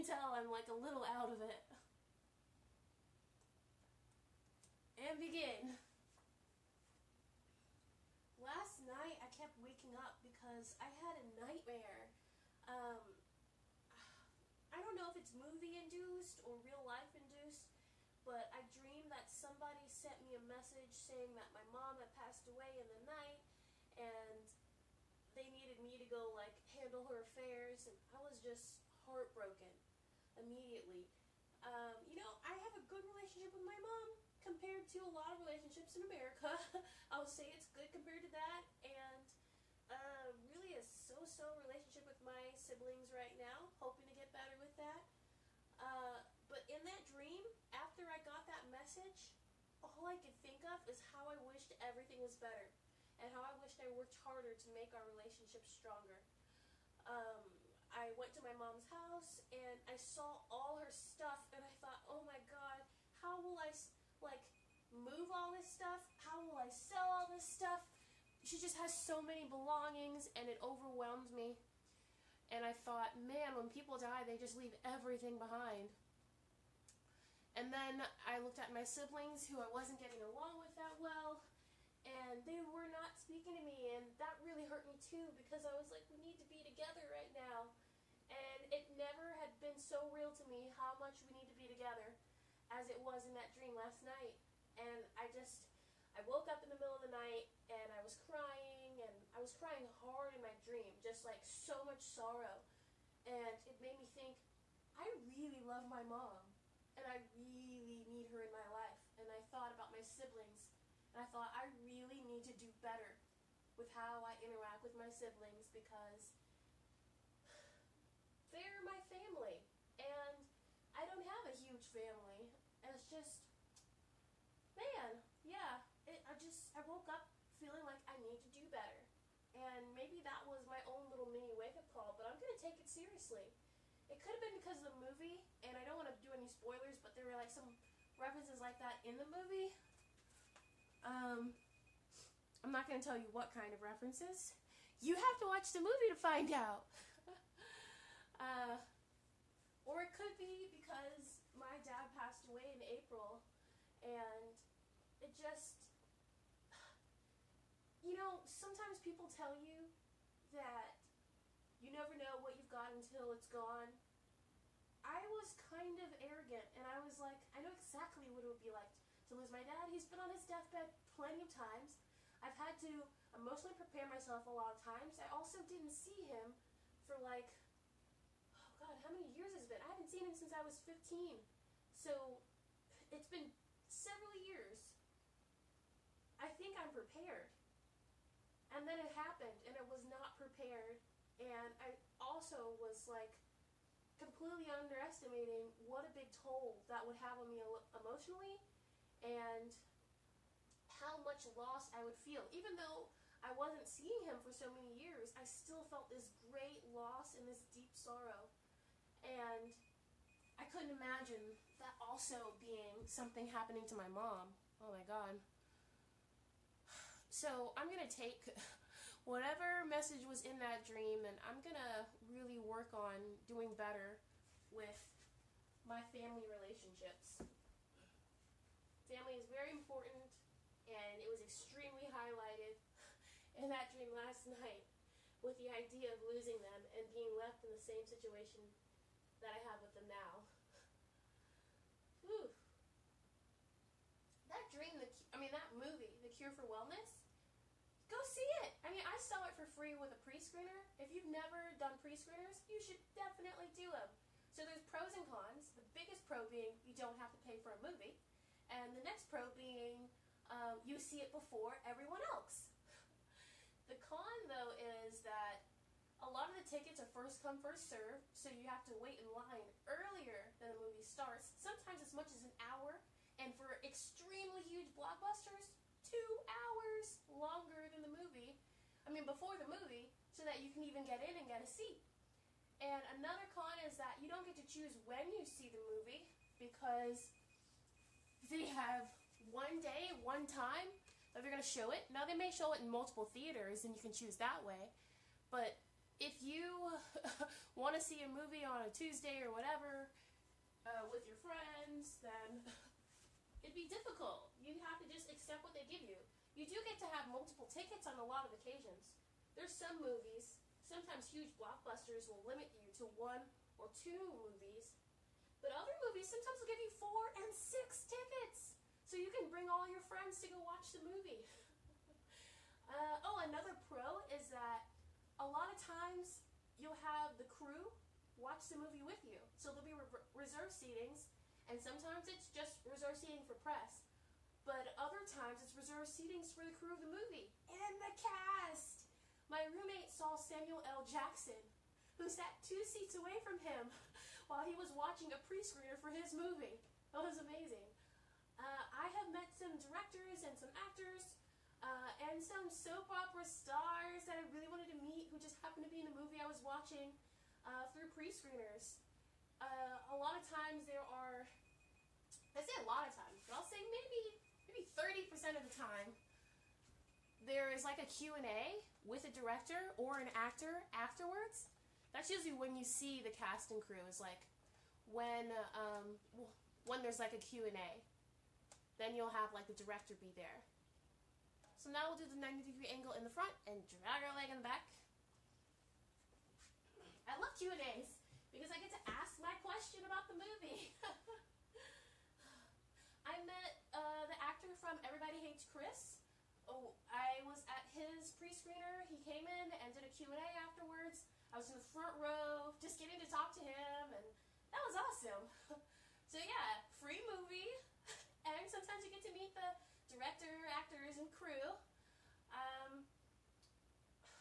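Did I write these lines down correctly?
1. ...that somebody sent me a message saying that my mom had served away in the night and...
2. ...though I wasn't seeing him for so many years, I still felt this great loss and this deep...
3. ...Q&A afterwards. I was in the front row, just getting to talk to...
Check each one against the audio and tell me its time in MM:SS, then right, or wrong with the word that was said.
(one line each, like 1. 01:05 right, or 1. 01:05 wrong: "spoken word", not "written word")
1. 00:19 wrong: "passed", not "served"
2. 03:22 right
3. 06:40 right.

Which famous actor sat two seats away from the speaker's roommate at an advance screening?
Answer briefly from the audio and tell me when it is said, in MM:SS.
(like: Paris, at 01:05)
Samuel L. Jackson, at 05:40.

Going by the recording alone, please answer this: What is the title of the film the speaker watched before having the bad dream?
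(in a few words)
The Cure for Wellness.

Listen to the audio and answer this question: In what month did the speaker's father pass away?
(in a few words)
April.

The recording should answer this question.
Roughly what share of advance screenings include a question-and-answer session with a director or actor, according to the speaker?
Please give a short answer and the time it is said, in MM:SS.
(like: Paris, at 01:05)
30%, at 06:04.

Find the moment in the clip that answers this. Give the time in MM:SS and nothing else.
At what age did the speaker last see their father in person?
03:00.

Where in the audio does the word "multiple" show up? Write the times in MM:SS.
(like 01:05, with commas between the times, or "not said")
04:52, 05:07.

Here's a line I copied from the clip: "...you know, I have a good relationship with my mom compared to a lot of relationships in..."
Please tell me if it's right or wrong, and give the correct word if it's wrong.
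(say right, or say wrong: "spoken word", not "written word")
right.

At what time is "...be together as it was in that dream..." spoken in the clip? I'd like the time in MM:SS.
01:31.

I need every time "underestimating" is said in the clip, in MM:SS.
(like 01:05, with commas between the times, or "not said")
03:14.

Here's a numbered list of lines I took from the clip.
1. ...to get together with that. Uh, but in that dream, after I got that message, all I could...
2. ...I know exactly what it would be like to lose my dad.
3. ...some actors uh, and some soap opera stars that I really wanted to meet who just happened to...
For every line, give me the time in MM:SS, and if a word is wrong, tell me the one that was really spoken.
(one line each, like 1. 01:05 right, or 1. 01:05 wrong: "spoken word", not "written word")
1. 00:44 wrong: "better", not "together"
2. 02:47 right
3. 05:50 right.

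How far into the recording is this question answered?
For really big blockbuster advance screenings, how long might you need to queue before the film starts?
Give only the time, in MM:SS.
04:36.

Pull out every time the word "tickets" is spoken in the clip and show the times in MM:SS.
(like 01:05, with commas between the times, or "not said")
04:26, 05:07, 05:18.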